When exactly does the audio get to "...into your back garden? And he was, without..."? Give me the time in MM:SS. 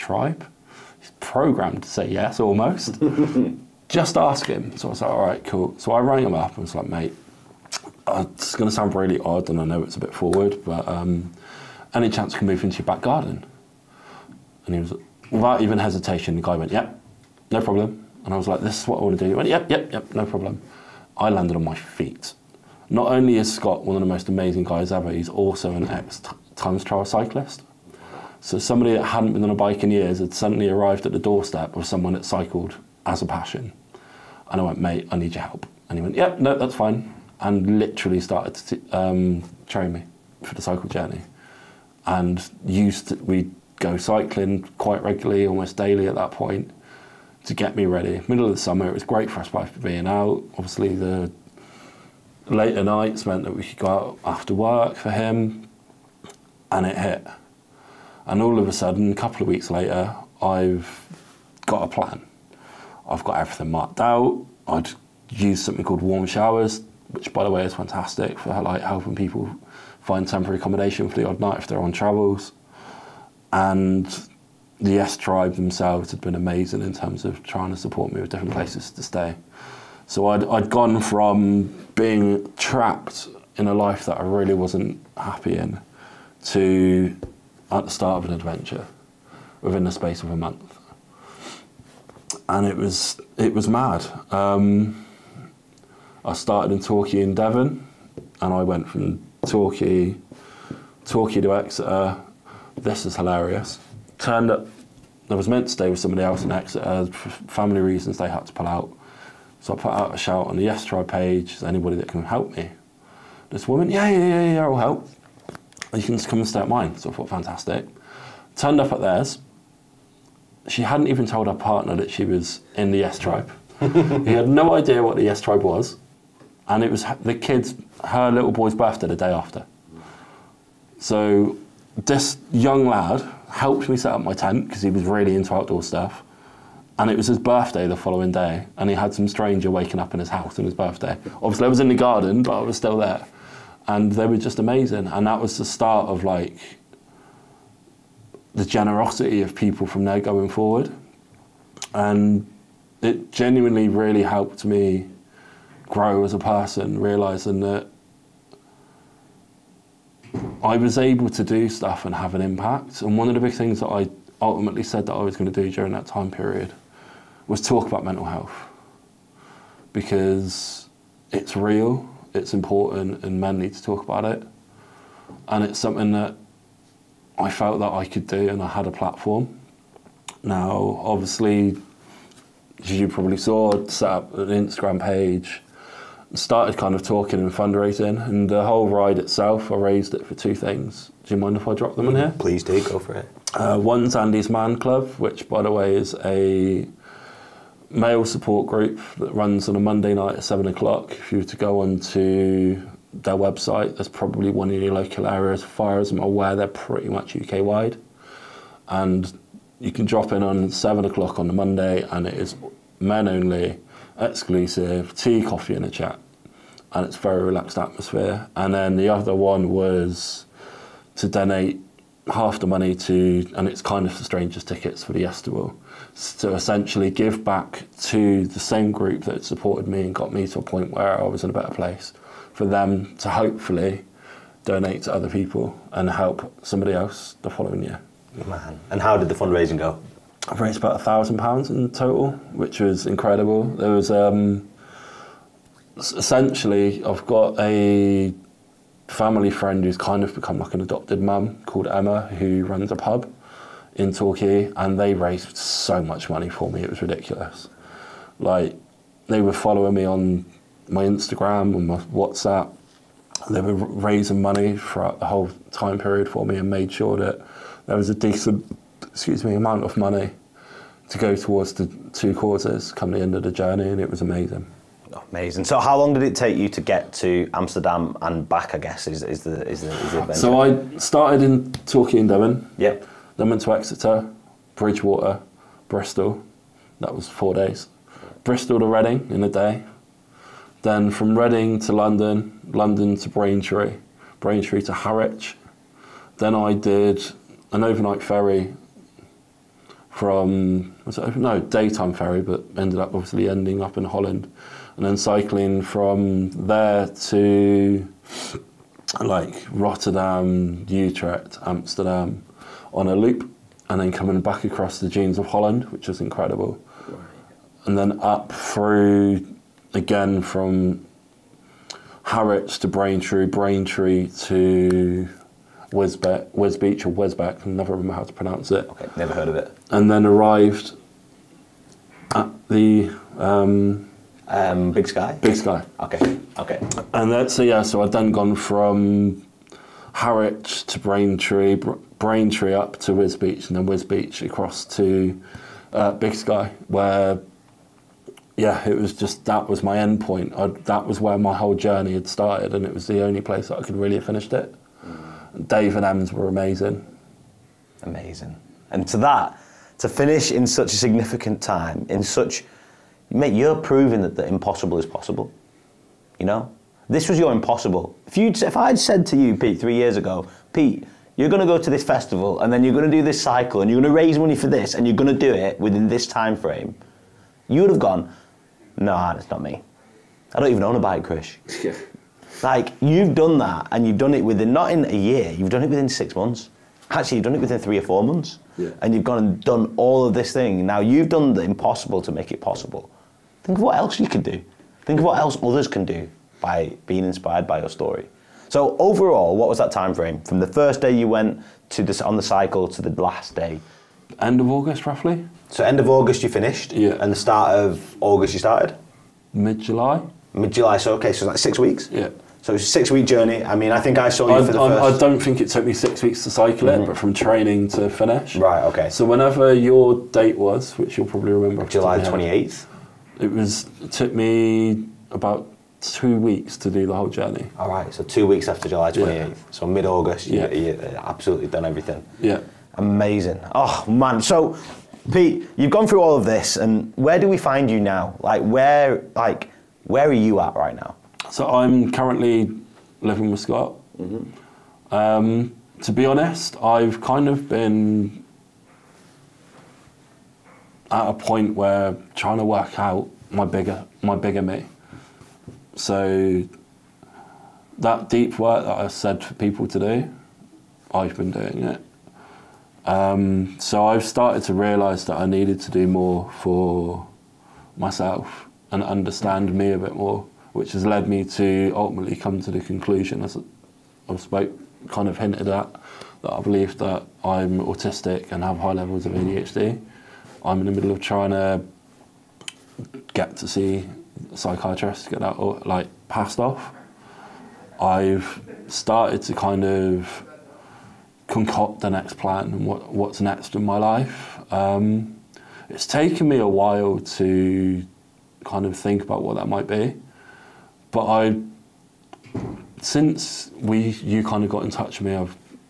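00:12.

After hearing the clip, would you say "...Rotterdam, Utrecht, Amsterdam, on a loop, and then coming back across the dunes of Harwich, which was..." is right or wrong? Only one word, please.
wrong.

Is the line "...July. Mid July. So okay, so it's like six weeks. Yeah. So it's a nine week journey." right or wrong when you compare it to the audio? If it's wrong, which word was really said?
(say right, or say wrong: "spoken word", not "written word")
wrong: "six", not "nine".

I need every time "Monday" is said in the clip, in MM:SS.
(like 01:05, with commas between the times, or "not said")
03:19, 03:31.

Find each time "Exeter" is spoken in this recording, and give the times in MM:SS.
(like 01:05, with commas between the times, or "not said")
01:41, 01:46, 04:43.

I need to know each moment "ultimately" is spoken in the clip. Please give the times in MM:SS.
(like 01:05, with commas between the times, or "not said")
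02:44, 07:51.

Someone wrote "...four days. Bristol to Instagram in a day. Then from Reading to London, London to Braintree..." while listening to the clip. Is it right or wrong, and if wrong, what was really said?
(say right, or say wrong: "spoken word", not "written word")
wrong: "Reading", not "Instagram".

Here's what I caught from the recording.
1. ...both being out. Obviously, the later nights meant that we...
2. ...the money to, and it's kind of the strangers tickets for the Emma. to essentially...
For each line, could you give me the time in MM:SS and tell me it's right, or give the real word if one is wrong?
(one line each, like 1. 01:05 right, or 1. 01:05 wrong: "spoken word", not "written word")
1. 00:49 right
2. 03:42 wrong: "Yestival", not "Emma".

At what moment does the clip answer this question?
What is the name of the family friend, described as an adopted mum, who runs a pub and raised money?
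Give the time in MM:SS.
04:11.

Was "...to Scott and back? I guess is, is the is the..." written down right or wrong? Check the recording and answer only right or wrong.
wrong.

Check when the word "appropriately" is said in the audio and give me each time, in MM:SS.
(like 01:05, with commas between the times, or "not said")
not said.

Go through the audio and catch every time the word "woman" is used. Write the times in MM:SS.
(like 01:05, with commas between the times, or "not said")
01:53.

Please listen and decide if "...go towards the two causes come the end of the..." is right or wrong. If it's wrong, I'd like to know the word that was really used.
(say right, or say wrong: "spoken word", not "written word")
right.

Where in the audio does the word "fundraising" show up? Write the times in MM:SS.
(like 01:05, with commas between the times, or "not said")
03:07, 03:59.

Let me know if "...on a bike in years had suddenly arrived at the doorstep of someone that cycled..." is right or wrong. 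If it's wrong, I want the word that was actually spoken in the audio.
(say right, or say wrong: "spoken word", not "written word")
right.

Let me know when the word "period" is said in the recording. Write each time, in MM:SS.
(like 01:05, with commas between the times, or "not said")
02:46, 04:25.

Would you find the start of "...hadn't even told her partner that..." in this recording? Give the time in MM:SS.
02:00.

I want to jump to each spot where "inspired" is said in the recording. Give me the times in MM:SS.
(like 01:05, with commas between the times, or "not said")
06:37.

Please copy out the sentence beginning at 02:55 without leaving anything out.
And it's something that I felt that I could do and I had a platform.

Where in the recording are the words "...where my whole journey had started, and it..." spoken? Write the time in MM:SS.
05:51.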